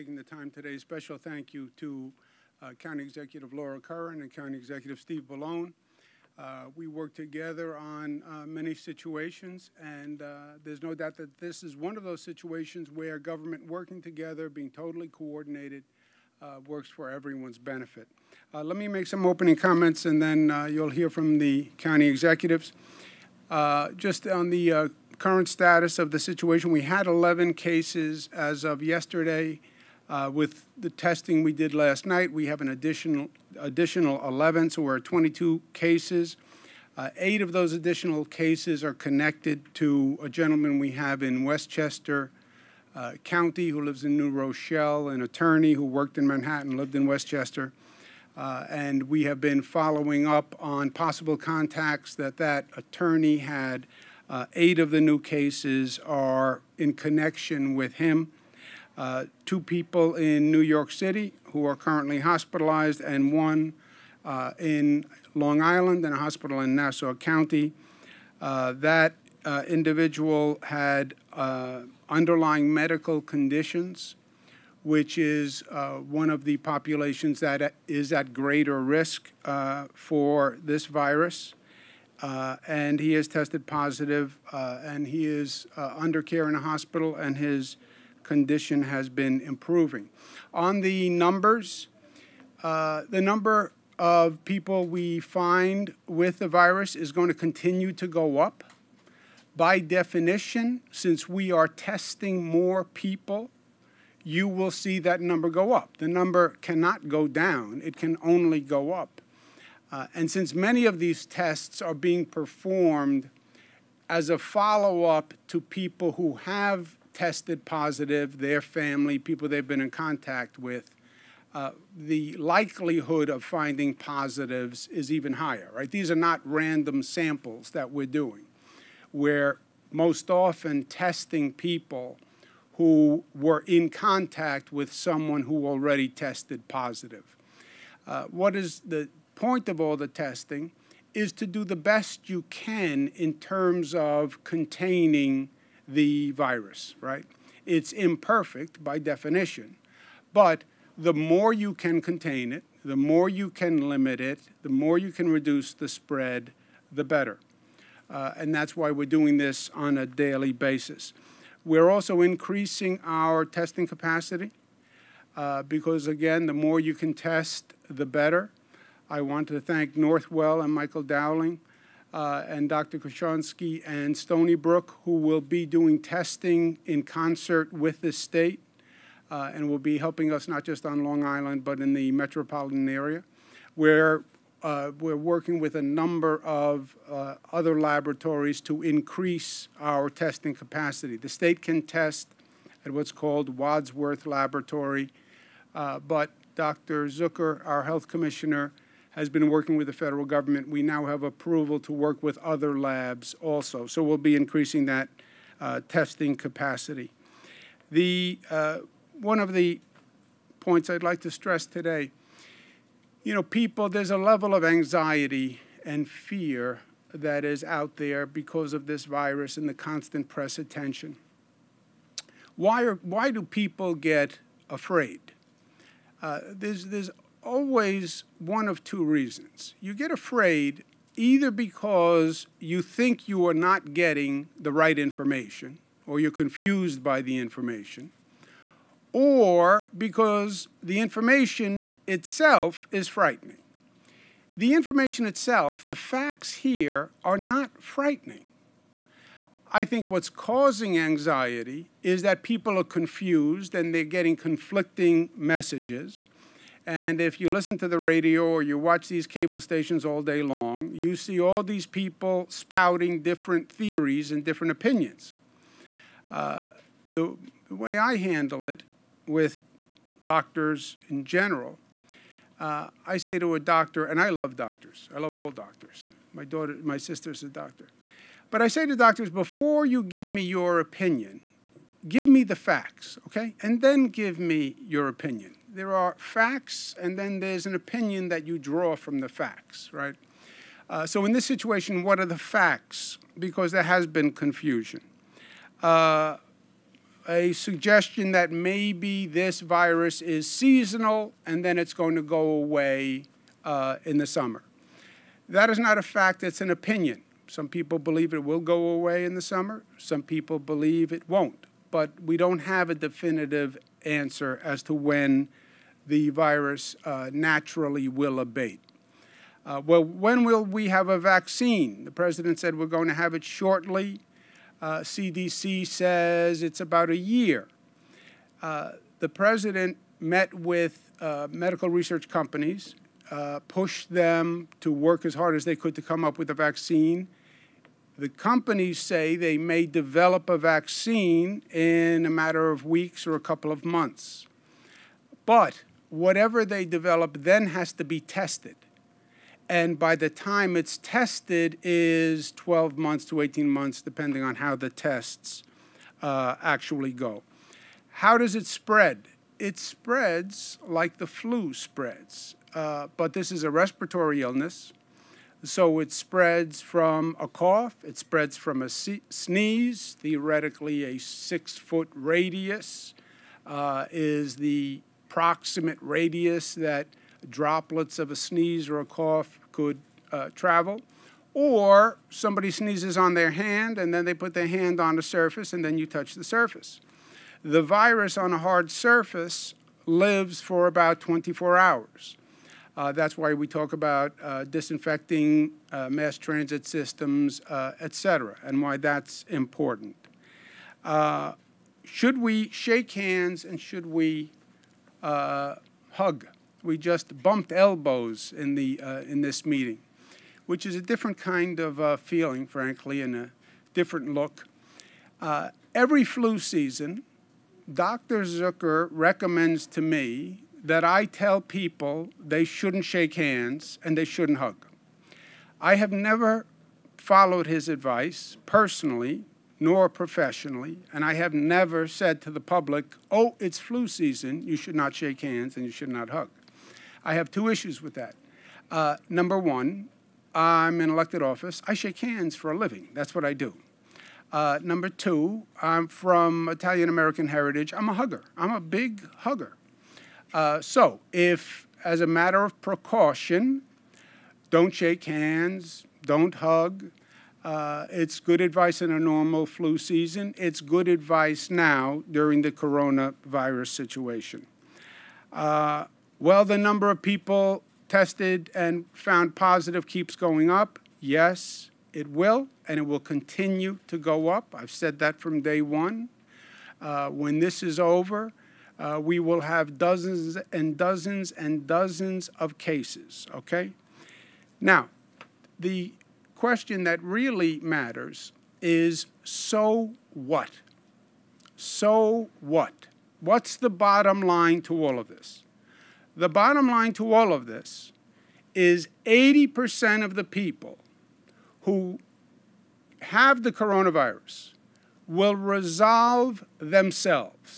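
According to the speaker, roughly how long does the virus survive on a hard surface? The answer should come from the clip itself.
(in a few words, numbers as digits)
24 hours.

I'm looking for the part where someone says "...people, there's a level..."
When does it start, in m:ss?
3:33.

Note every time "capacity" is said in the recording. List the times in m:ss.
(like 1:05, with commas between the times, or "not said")
2:43, 3:10, 3:26.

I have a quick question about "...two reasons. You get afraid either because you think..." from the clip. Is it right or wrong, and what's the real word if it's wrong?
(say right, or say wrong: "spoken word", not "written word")
right.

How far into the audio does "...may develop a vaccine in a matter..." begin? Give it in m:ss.
5:39.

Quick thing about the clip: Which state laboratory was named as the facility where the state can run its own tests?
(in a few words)
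Wadsworth Laboratory.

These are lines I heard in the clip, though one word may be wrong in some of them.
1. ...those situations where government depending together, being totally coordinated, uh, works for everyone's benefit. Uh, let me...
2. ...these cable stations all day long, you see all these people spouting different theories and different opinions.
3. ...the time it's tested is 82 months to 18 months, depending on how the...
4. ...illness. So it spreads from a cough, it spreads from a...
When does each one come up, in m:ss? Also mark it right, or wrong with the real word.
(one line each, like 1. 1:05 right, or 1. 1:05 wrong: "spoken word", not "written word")
1. 0:12 wrong: "working", not "depending"
2. 4:19 right
3. 5:50 wrong: "12", not "82"
4. 6:04 right.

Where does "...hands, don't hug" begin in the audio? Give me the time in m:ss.
7:35.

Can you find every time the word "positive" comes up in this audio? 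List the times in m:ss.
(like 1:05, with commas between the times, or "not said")
1:23, 1:57, 2:03, 2:16, 7:49.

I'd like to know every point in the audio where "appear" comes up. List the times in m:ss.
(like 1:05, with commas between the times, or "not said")
not said.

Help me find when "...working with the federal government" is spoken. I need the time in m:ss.
3:19.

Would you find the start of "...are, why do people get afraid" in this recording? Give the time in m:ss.
3:42.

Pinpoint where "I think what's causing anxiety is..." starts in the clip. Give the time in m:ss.
4:09.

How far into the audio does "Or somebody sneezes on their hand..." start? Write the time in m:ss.
6:21.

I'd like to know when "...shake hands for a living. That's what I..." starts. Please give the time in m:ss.
7:21.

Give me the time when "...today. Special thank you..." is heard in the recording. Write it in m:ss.
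0:00.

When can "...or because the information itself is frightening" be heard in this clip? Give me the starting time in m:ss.
3:59.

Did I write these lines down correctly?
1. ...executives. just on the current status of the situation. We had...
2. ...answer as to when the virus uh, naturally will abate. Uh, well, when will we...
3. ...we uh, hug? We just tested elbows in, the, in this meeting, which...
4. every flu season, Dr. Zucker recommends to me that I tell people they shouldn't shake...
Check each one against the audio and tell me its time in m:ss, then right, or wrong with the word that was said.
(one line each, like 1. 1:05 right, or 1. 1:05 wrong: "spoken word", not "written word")
1. 0:22 right
2. 5:14 right
3. 6:44 wrong: "bumped", not "tested"
4. 6:55 right.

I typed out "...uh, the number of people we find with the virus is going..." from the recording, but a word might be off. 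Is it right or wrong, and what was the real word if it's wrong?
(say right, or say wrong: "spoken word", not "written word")
right.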